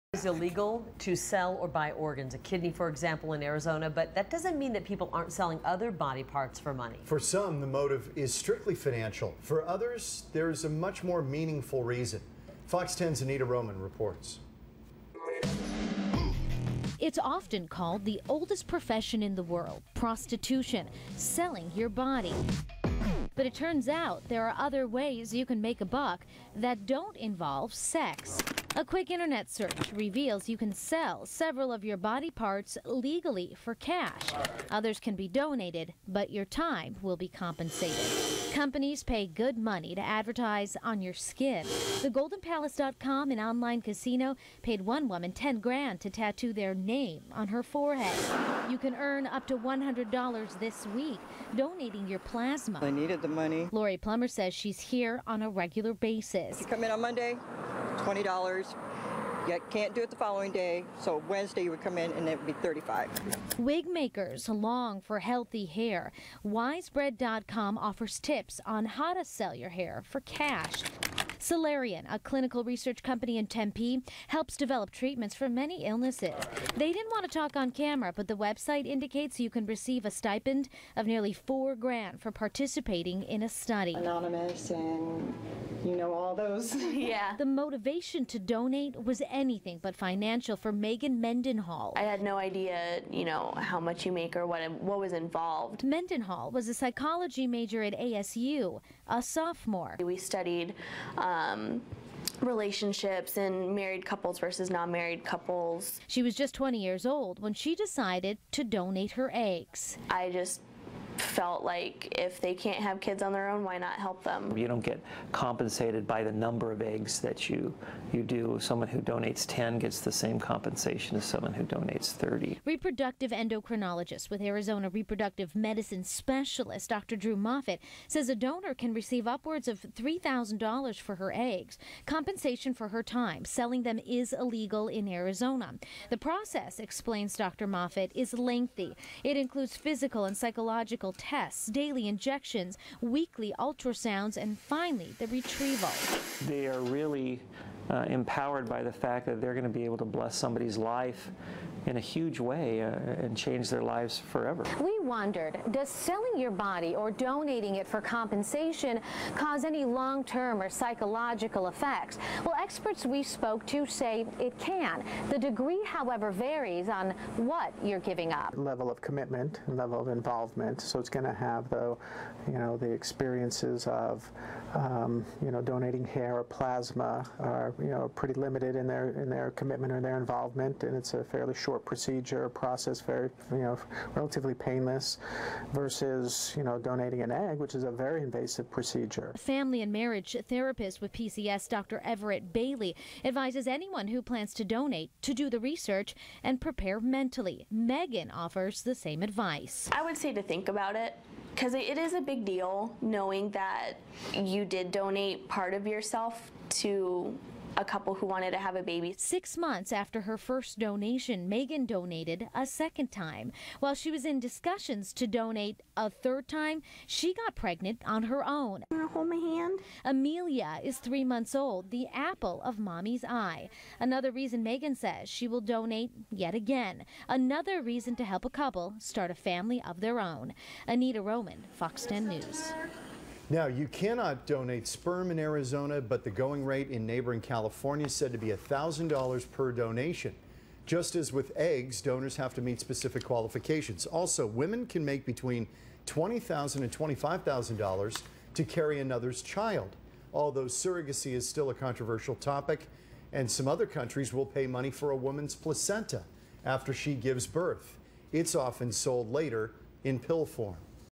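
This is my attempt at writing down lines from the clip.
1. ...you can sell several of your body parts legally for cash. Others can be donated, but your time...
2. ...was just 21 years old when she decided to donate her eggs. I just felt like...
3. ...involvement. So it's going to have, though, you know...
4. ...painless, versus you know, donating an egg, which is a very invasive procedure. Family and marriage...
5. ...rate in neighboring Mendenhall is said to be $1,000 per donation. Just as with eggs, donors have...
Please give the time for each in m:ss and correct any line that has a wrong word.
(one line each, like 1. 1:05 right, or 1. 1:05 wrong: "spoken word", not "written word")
1. 0:30 right
2. 1:46 wrong: "20", not "21"
3. 2:50 right
4. 3:04 right
5. 3:56 wrong: "California", not "Mendenhall".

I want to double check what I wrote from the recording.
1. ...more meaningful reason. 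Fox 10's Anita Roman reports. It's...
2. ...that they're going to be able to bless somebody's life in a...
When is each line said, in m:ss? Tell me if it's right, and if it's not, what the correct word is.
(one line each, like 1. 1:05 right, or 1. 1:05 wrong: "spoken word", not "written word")
1. 0:11 right
2. 2:29 right.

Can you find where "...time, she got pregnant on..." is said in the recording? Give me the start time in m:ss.
3:36.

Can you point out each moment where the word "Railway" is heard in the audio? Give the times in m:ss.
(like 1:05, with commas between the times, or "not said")
not said.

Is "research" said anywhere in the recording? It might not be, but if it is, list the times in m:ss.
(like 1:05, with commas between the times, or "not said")
1:12, 3:15.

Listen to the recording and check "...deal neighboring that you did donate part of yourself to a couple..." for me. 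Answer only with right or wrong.
wrong.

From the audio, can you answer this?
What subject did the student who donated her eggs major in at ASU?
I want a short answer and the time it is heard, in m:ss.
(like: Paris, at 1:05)
Psychology, at 1:36.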